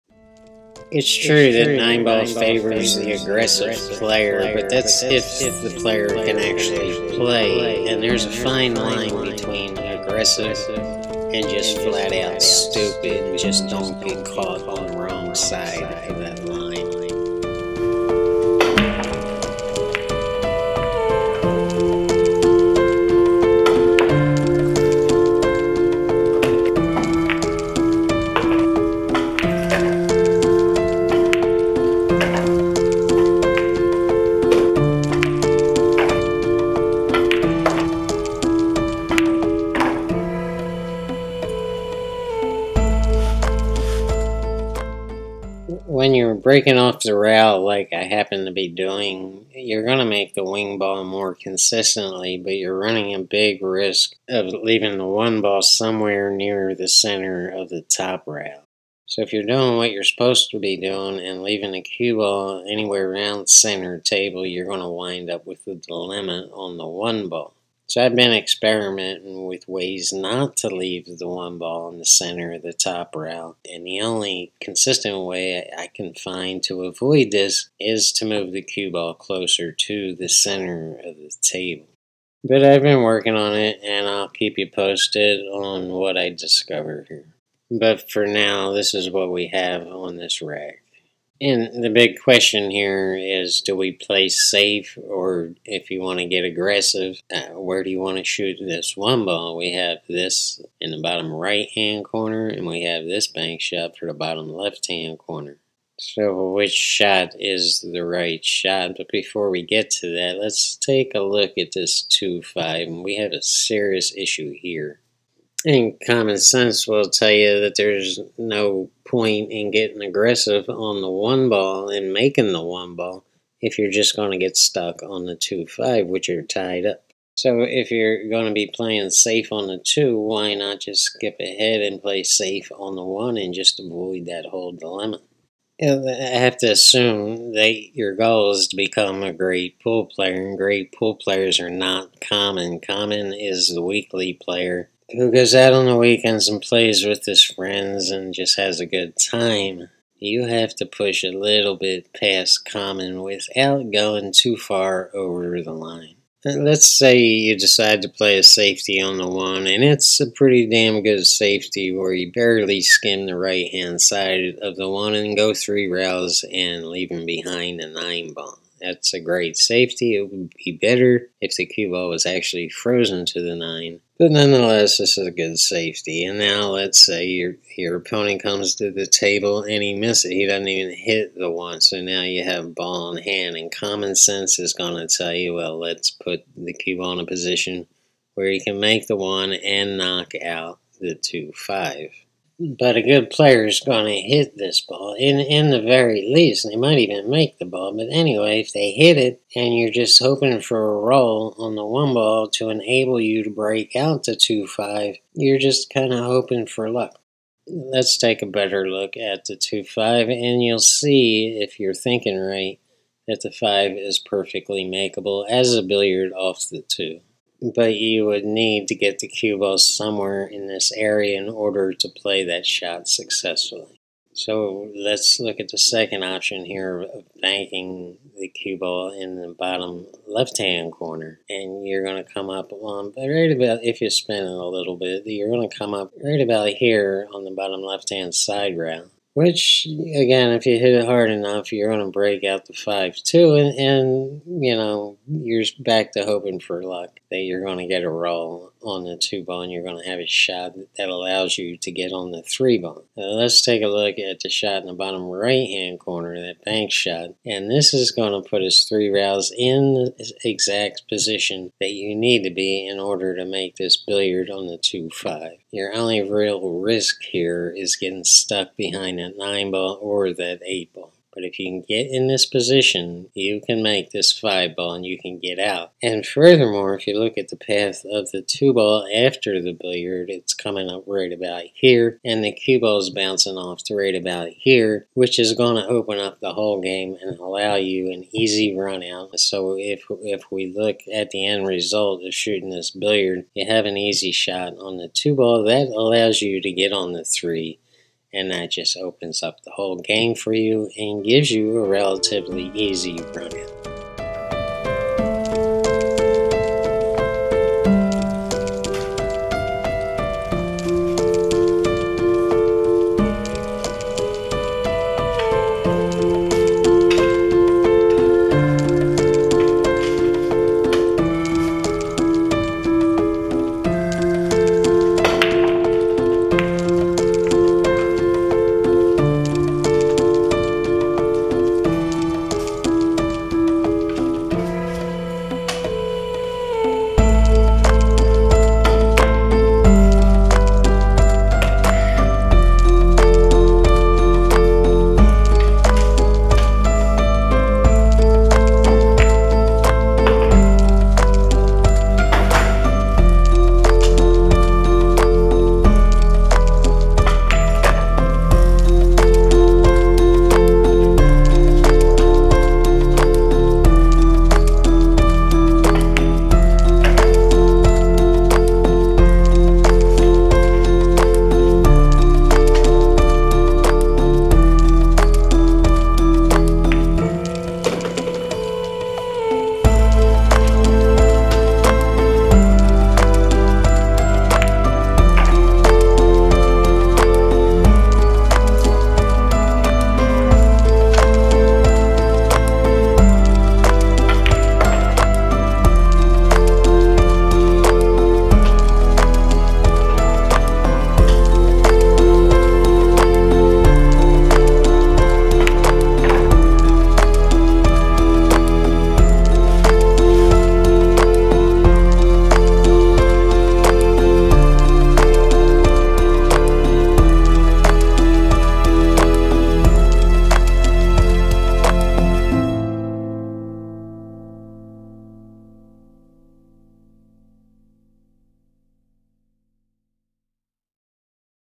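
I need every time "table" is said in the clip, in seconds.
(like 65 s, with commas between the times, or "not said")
63 s, 81 s, 179 s.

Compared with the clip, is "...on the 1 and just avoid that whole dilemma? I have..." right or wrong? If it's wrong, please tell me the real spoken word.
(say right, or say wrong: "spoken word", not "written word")
right.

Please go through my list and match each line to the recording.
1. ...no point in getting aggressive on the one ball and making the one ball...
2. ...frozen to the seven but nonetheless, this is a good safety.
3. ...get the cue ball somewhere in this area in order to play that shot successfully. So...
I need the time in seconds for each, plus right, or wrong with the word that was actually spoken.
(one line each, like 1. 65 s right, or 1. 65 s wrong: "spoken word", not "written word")
1. 118 s right
2. 172 s wrong: "nine", not "seven"
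3. 218 s right.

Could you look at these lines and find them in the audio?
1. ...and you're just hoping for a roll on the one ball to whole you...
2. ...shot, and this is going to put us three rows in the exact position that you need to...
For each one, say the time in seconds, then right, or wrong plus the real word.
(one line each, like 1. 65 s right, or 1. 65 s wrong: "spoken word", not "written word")
1. 199 s wrong: "enable", not "whole"
2. 256 s right.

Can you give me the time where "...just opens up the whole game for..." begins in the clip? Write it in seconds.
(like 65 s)
298 s.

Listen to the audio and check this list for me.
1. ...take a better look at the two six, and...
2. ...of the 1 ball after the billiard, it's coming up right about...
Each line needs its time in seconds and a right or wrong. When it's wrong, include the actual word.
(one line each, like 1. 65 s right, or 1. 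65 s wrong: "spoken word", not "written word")
1. 208 s wrong: "five", not "six"
2. 278 s wrong: "2", not "1".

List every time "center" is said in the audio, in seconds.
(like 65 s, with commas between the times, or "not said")
56 s, 63 s, 72 s, 80 s.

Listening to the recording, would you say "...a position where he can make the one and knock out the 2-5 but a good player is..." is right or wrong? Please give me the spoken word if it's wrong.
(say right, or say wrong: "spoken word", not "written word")
right.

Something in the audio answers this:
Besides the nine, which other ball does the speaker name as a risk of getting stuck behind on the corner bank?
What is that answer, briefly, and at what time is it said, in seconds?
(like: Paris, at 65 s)
8 ball, at 270 s.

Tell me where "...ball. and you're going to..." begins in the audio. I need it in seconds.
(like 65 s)
249 s.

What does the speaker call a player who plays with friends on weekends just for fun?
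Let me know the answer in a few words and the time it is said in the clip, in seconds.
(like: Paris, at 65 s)
weekly player, at 143 s.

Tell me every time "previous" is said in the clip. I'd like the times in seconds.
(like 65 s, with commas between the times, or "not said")
not said.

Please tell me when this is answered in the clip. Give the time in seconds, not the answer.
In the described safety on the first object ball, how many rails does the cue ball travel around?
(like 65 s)
165 s.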